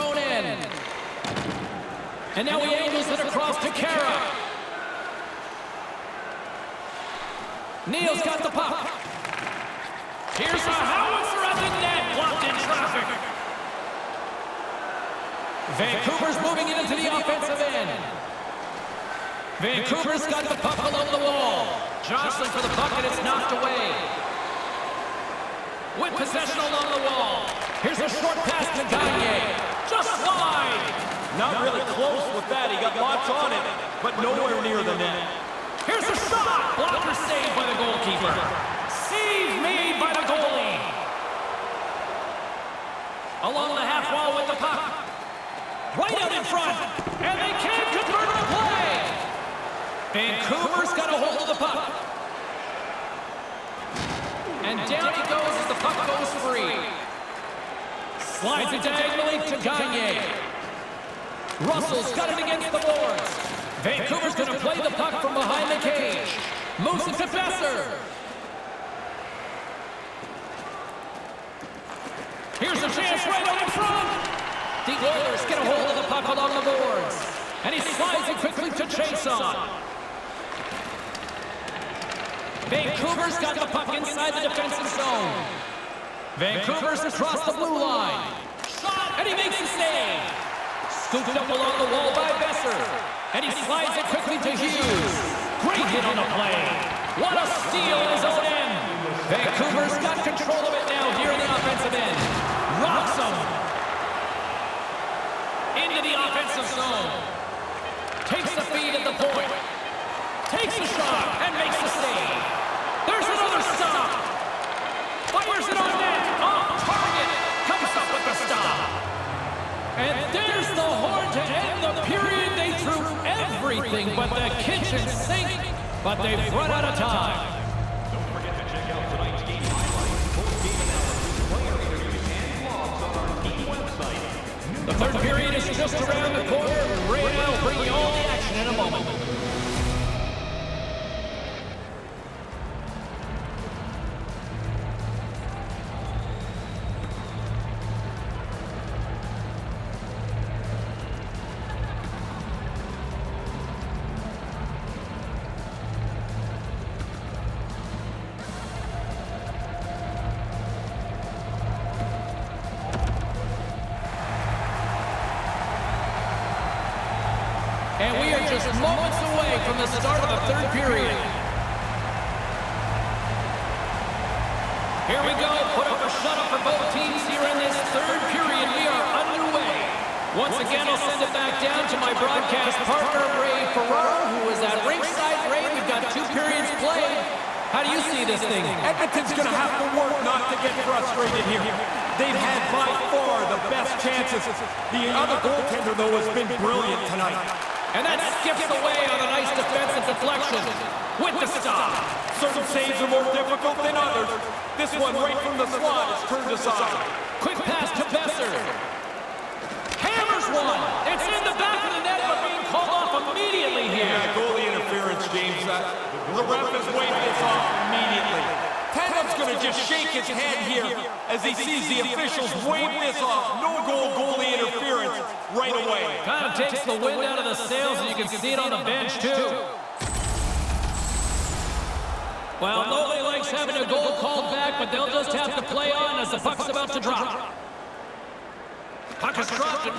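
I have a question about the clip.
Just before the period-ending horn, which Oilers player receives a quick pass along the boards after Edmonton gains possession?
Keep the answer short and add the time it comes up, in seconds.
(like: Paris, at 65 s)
Chiasson, at 78 s.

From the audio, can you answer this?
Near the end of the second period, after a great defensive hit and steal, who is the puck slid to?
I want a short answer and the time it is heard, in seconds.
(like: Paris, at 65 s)
Hughes, at 94 s.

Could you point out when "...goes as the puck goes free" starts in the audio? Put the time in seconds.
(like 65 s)
55 s.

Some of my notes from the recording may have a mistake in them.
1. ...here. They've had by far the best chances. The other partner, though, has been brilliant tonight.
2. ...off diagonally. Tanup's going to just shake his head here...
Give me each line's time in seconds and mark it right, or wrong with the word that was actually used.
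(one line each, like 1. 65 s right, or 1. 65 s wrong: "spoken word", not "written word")
1. 191 s wrong: "goaltender", not "partner"
2. 217 s wrong: "immediately", not "diagonally".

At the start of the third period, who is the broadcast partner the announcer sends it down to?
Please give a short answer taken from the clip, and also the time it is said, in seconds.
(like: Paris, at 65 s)
Ray Ferraro, at 183 s.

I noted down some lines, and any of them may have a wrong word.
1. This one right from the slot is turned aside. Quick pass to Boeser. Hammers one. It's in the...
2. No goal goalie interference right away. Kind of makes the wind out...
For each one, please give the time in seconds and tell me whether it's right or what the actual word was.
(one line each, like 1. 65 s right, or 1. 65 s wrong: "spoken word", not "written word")
1. 204 s right
2. 223 s wrong: "takes", not "makes".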